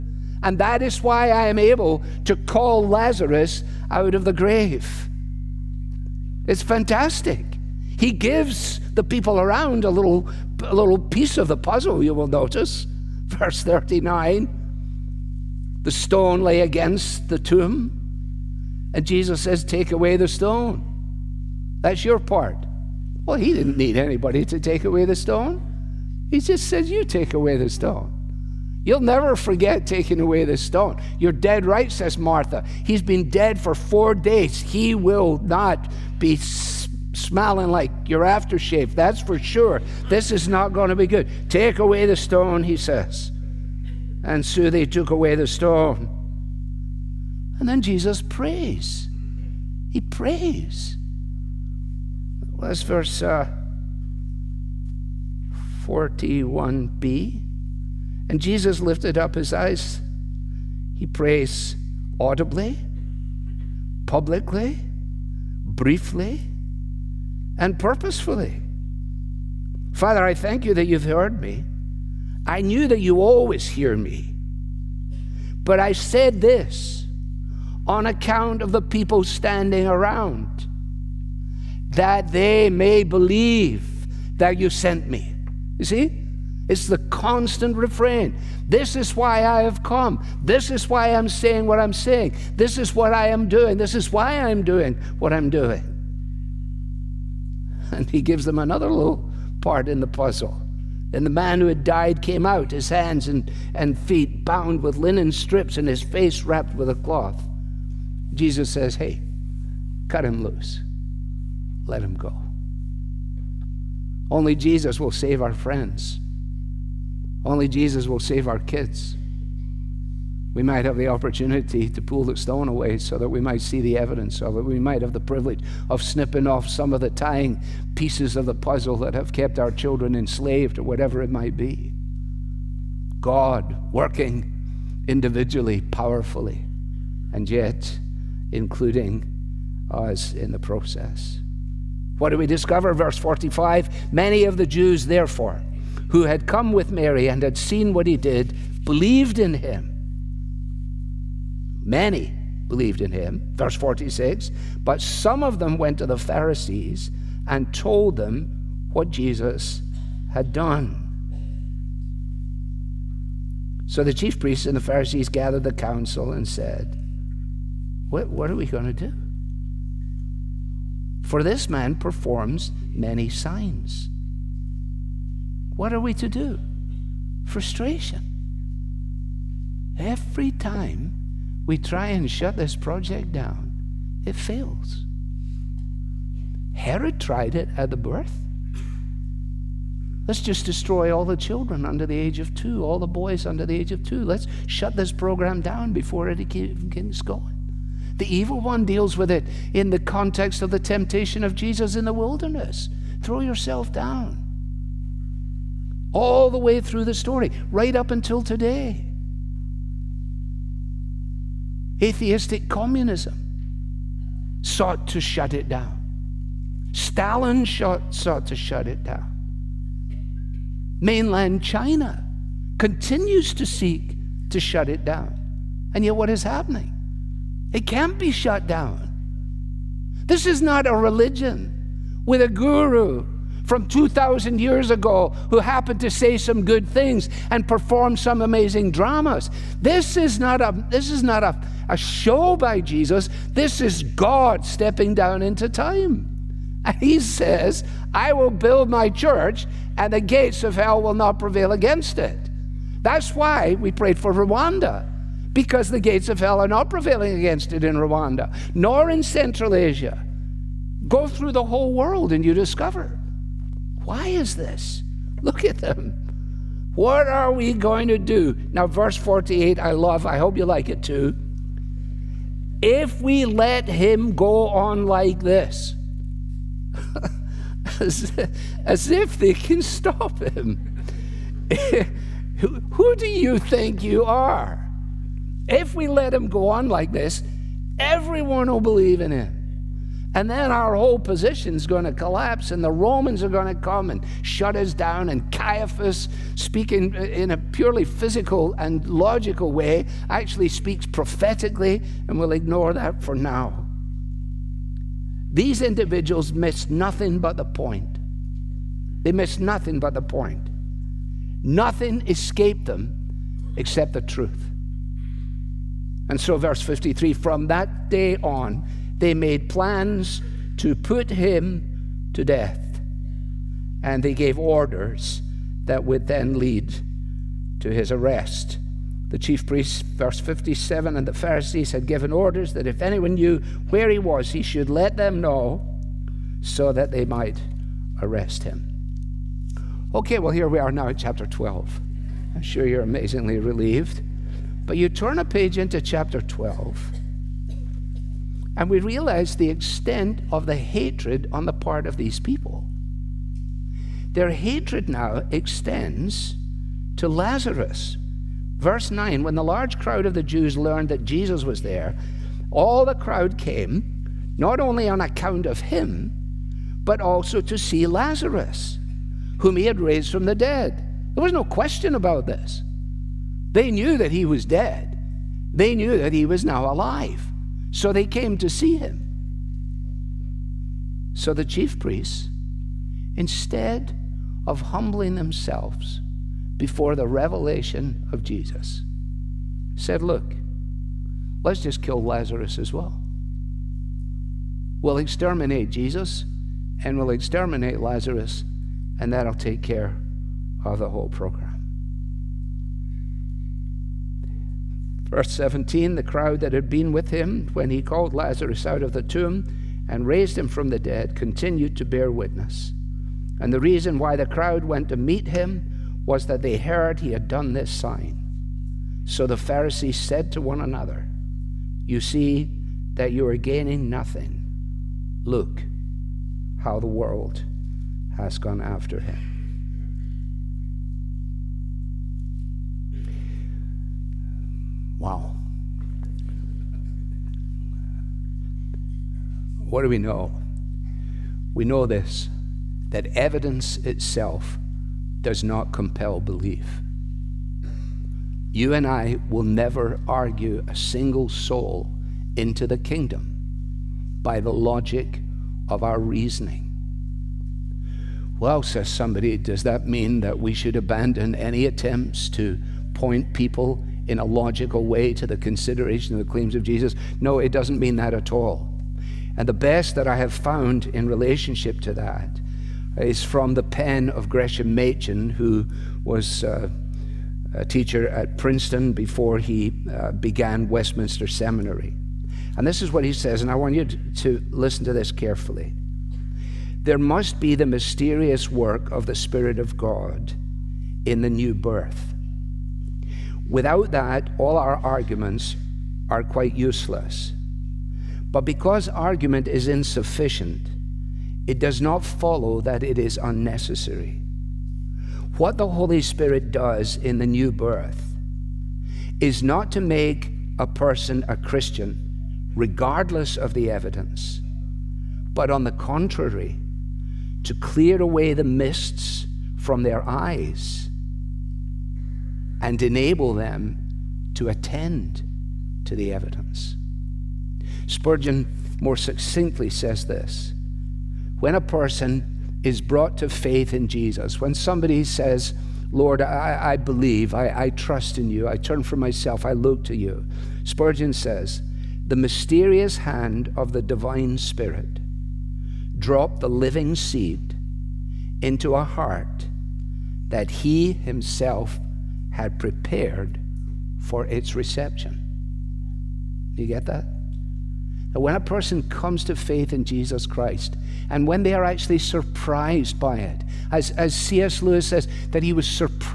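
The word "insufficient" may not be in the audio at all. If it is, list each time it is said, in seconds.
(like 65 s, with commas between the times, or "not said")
499 s.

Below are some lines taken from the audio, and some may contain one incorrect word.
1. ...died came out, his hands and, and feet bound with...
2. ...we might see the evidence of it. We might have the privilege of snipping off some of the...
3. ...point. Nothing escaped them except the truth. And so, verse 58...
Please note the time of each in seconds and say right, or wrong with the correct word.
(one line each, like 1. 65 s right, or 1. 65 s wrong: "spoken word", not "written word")
1. 101 s right
2. 123 s right
3. 310 s wrong: "53", not "58".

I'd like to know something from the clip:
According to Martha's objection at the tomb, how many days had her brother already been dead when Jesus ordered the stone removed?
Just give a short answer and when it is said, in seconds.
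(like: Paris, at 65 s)
4, at 33 s.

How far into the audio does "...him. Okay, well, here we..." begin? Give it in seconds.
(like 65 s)
338 s.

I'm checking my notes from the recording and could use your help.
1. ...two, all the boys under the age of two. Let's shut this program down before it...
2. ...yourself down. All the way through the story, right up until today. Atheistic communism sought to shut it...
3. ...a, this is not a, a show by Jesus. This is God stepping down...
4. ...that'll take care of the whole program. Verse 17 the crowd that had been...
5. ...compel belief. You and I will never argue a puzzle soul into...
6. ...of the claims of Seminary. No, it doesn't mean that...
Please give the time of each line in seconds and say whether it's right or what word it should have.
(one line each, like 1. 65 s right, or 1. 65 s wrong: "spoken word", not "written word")
1. 192 s right
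2. 203 s right
3. 240 s right
4. 399 s right
5. 445 s wrong: "single", not "puzzle"
6. 466 s wrong: "Jesus", not "Seminary".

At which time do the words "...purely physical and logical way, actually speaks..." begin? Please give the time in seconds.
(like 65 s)
297 s.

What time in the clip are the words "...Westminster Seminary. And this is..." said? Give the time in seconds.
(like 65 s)
480 s.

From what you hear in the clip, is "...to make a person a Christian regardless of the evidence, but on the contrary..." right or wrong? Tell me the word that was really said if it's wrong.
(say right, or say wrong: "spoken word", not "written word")
right.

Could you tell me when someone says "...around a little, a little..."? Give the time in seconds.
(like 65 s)
9 s.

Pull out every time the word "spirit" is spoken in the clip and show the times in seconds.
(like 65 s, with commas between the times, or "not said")
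489 s, 506 s, 544 s.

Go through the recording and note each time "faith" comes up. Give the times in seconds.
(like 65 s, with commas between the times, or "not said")
533 s, 559 s.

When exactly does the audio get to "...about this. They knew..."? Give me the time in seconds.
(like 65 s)
372 s.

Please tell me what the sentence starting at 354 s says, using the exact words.
Their hatred now extends to Lazarus.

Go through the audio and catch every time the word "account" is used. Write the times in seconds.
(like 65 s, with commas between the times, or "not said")
78 s, 365 s.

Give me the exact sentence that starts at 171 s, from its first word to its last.
For this man performs many signs.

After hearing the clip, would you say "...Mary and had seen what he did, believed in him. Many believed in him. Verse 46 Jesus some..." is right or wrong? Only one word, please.
wrong.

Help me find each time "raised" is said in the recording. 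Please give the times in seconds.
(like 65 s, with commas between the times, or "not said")
369 s, 410 s.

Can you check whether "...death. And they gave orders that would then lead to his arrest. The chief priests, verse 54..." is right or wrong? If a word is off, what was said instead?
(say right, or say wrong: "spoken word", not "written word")
wrong: "57", not "54".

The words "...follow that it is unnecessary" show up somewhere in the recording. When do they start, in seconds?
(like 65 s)
502 s.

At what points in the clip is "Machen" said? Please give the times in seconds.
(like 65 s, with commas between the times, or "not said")
474 s.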